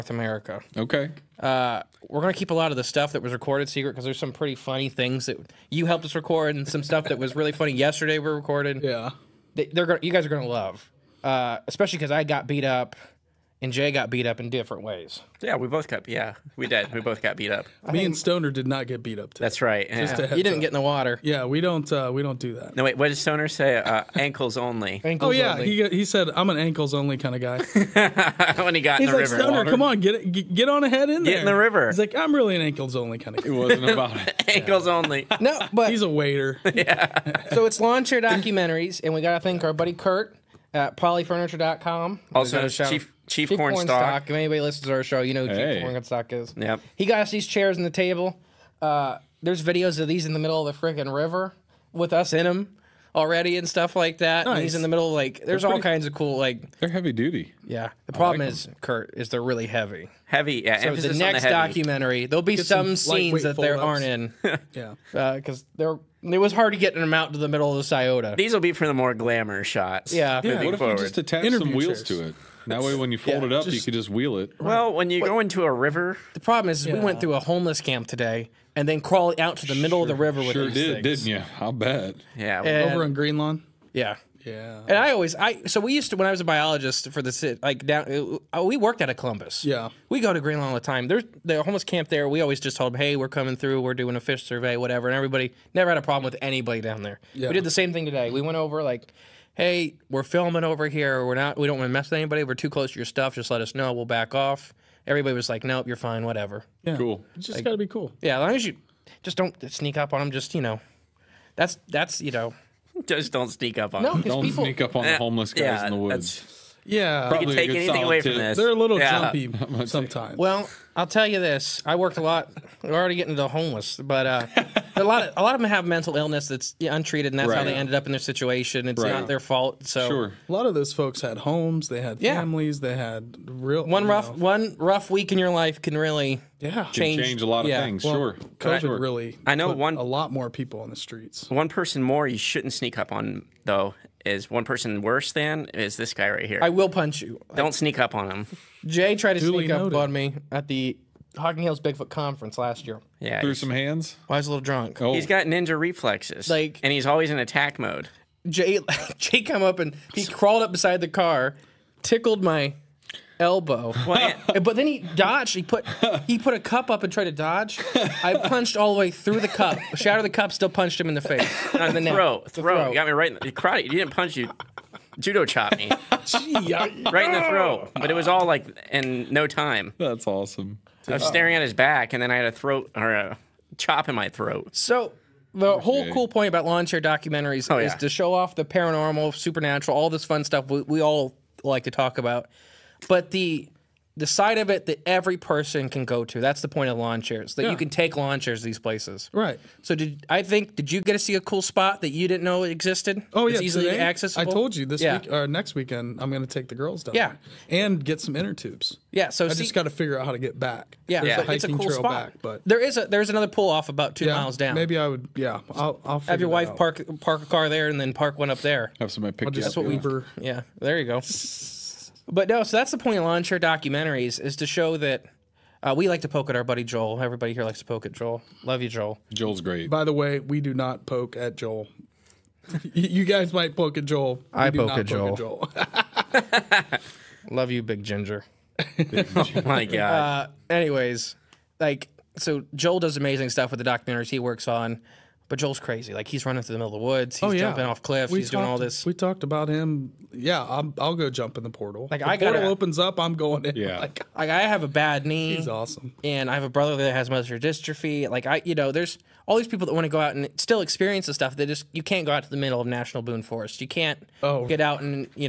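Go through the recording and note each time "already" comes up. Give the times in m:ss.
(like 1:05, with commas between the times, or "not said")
0:53, 2:02.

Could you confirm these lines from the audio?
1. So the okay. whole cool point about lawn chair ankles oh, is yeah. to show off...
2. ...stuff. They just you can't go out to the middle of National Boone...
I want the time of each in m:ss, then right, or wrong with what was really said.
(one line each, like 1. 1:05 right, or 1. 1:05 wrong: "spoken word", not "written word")
1. 3:04 wrong: "documentaries", not "ankles"
2. 4:21 right.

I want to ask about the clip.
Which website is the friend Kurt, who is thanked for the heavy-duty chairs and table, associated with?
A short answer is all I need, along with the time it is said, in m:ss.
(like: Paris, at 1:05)
polyfurniture.com, at 0:40.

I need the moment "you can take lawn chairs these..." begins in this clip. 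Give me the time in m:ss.
3:17.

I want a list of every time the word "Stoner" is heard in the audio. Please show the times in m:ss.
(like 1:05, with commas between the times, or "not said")
0:18, 0:23, 0:29.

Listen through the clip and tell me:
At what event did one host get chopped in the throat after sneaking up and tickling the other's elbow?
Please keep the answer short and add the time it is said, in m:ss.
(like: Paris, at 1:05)
Hocking Hills Bigfoot conference, at 2:31.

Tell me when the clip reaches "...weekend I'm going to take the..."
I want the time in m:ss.
3:25.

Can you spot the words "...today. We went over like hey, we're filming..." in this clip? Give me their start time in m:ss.
1:38.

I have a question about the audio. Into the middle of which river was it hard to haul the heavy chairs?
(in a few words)
Scioto.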